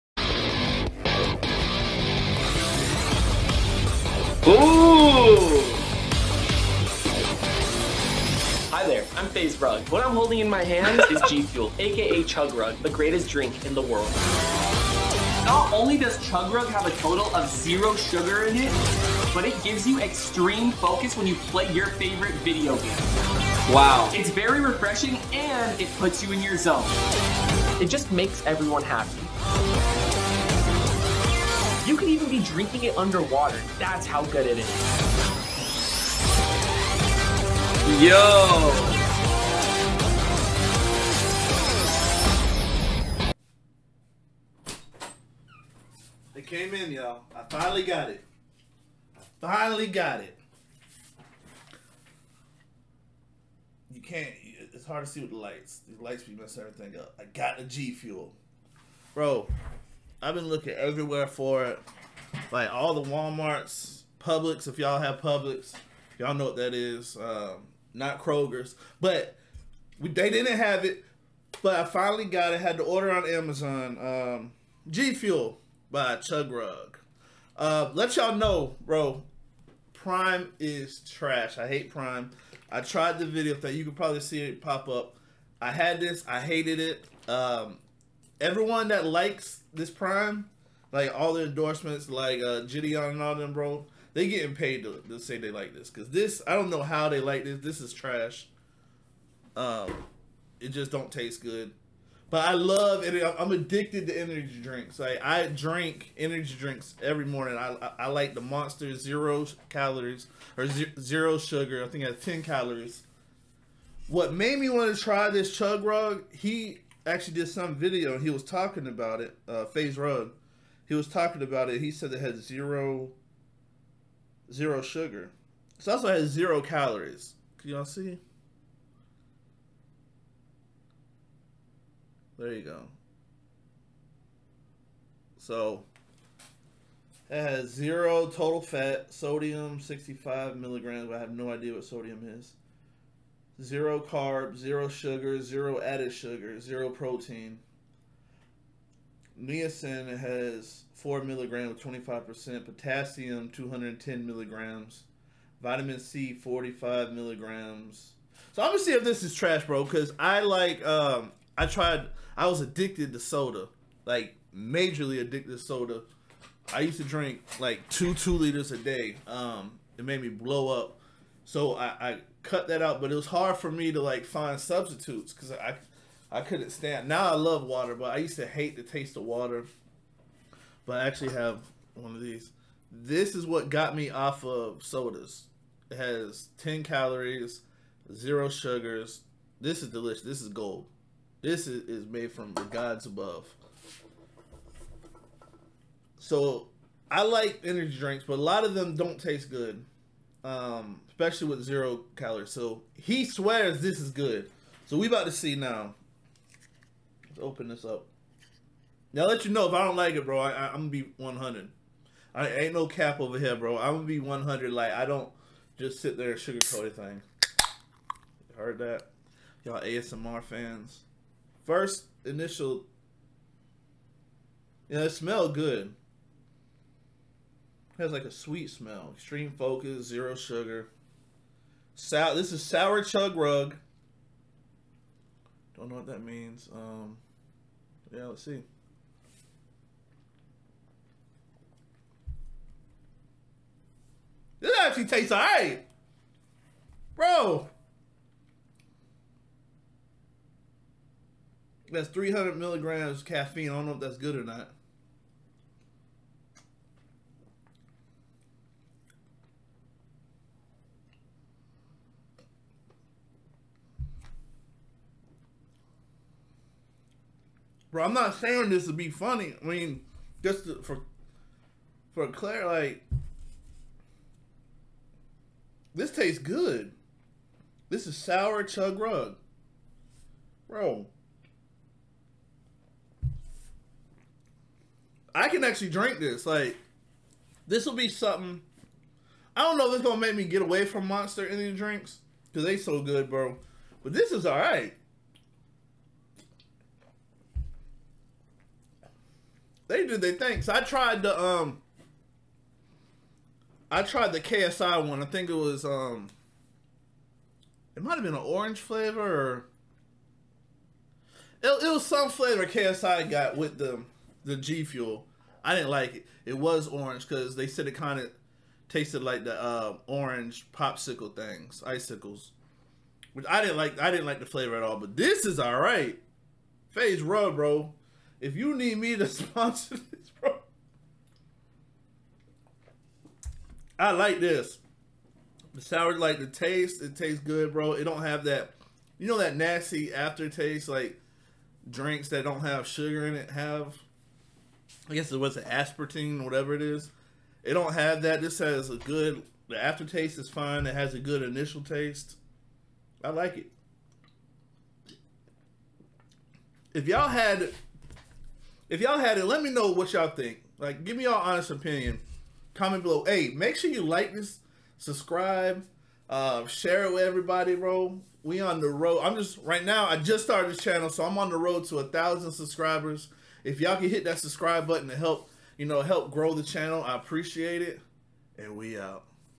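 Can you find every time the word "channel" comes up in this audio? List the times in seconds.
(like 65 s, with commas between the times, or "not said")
370 s, 376 s.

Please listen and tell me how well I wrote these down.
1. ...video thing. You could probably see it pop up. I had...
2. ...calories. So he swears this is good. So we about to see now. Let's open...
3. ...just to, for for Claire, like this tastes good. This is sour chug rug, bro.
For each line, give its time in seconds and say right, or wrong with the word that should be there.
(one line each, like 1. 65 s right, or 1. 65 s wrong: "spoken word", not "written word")
1. 83 s right
2. 202 s right
3. 270 s right.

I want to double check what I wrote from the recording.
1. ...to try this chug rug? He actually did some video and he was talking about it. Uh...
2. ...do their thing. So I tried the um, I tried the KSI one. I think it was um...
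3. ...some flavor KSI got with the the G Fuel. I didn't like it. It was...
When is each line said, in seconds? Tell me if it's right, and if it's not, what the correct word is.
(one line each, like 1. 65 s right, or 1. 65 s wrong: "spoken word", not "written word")
1. 114 s right
2. 300 s right
3. 312 s right.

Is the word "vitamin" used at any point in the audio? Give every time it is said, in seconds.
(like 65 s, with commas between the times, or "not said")
155 s.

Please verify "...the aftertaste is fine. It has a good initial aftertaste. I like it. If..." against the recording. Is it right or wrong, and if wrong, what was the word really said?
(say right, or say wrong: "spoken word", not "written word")
wrong: "taste", not "aftertaste".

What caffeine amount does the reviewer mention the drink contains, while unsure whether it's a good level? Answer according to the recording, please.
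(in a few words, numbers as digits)
300 milligrams.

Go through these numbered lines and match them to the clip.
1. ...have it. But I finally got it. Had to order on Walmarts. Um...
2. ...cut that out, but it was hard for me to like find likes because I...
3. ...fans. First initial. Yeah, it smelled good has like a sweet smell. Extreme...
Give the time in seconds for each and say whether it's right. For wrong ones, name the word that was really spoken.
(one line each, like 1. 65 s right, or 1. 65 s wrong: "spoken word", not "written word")
1. 70 s wrong: "Amazon", not "Walmarts"
2. 172 s wrong: "substitutes", not "likes"
3. 220 s right.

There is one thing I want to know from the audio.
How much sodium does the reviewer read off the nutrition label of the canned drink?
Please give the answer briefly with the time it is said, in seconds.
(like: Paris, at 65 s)
65 milligrams, at 139 s.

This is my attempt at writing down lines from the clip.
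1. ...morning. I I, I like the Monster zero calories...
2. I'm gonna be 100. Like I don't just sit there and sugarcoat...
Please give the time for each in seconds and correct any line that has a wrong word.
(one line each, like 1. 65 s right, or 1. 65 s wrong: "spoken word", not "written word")
1. 107 s right
2. 213 s right.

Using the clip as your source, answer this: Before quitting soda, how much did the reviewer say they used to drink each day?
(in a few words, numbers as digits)
2 liters.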